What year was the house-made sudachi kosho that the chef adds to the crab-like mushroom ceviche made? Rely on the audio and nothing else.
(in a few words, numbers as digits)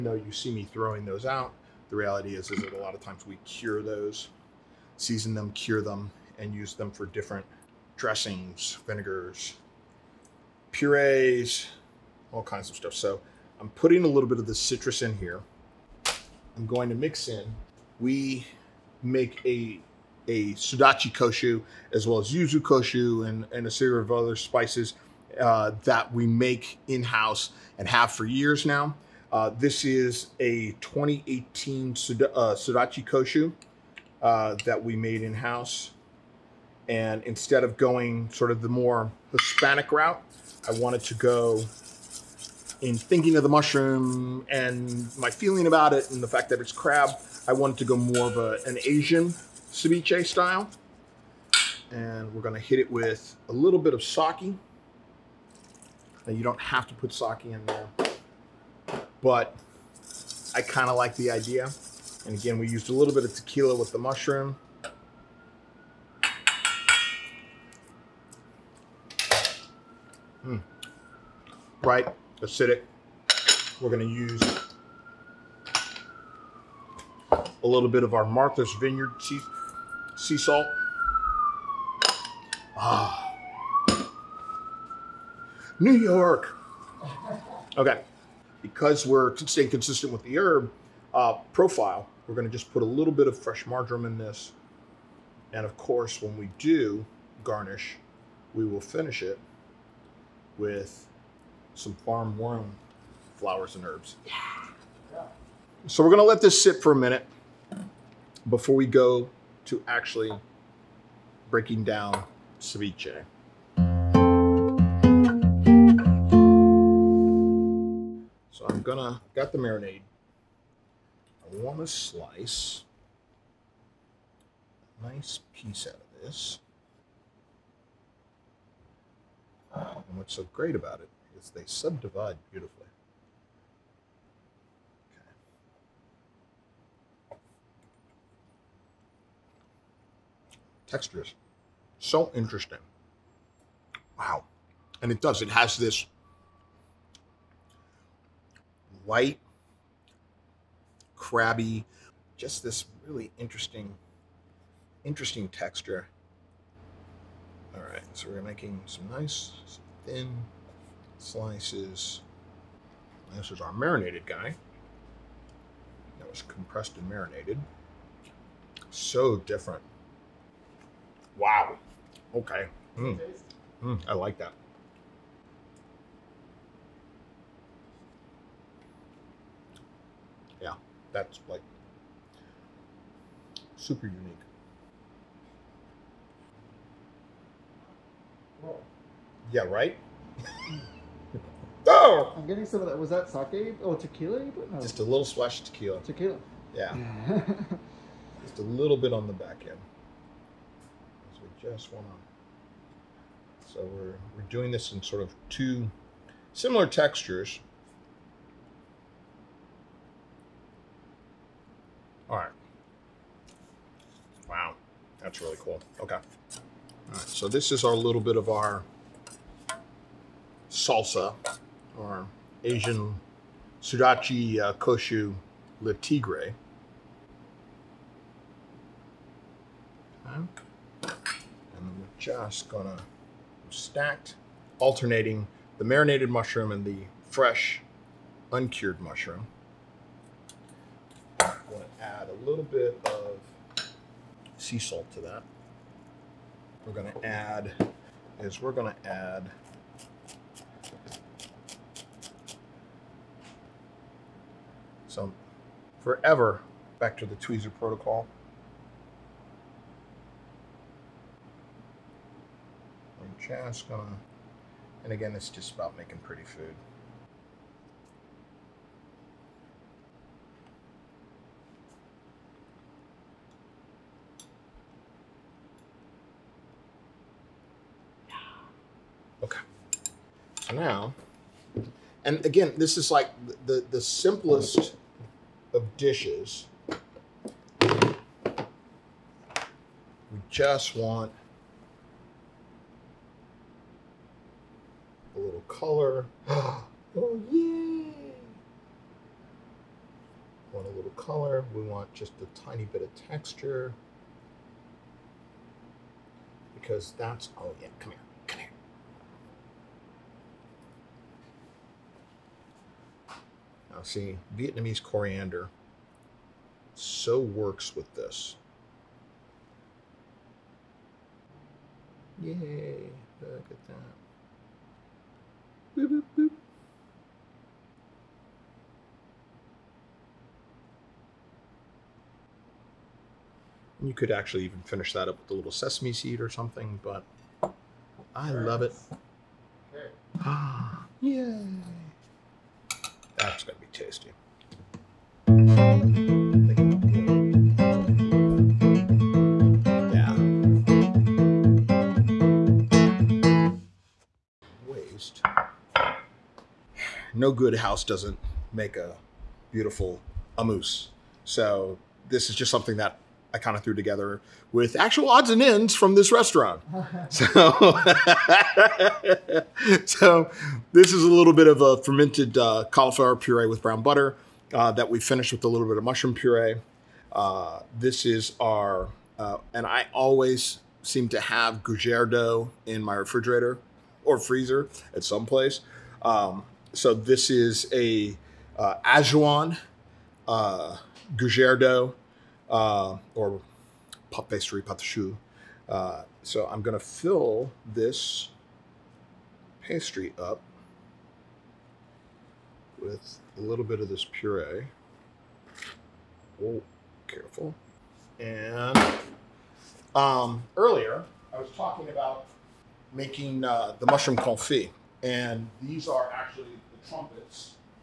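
2018.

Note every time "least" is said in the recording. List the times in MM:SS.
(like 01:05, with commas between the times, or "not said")
not said.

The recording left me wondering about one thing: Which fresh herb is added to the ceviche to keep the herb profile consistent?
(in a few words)
Marjoram.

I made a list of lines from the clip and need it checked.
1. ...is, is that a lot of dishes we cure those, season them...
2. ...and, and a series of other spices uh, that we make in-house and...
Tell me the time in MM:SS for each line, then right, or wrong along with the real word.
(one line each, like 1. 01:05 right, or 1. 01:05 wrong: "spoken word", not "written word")
1. 00:02 wrong: "times", not "dishes"
2. 00:23 right.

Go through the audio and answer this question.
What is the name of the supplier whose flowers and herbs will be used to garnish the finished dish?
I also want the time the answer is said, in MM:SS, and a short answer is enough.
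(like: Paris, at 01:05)
Farm One, at 01:42.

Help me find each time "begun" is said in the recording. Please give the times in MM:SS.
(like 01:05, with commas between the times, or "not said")
not said.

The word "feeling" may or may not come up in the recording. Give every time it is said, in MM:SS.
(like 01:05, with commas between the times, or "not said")
00:45.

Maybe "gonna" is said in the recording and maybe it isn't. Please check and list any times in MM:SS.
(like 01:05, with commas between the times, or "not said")
01:46, 01:58, 03:52, 04:01.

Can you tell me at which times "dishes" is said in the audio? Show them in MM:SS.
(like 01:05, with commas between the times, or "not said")
04:45.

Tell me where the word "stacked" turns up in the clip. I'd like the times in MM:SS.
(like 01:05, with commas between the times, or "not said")
03:53.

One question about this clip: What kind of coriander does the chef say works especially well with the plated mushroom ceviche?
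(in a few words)
Vietnamese coriander.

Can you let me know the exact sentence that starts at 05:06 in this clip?
Because that's, oh yeah, come here.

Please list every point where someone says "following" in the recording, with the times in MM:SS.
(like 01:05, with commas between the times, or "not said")
not said.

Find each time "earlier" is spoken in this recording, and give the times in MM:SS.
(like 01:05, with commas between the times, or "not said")
06:50.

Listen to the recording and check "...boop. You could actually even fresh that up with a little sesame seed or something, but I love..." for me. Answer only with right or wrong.
wrong.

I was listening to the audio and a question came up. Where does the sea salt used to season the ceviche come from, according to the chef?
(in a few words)
Martha's Vineyard.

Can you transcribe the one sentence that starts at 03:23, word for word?
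So we're, we're doing this in sort of two similar textures.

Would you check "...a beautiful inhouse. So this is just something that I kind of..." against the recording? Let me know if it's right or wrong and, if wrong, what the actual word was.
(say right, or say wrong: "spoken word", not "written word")
wrong: "amuse", not "inhouse".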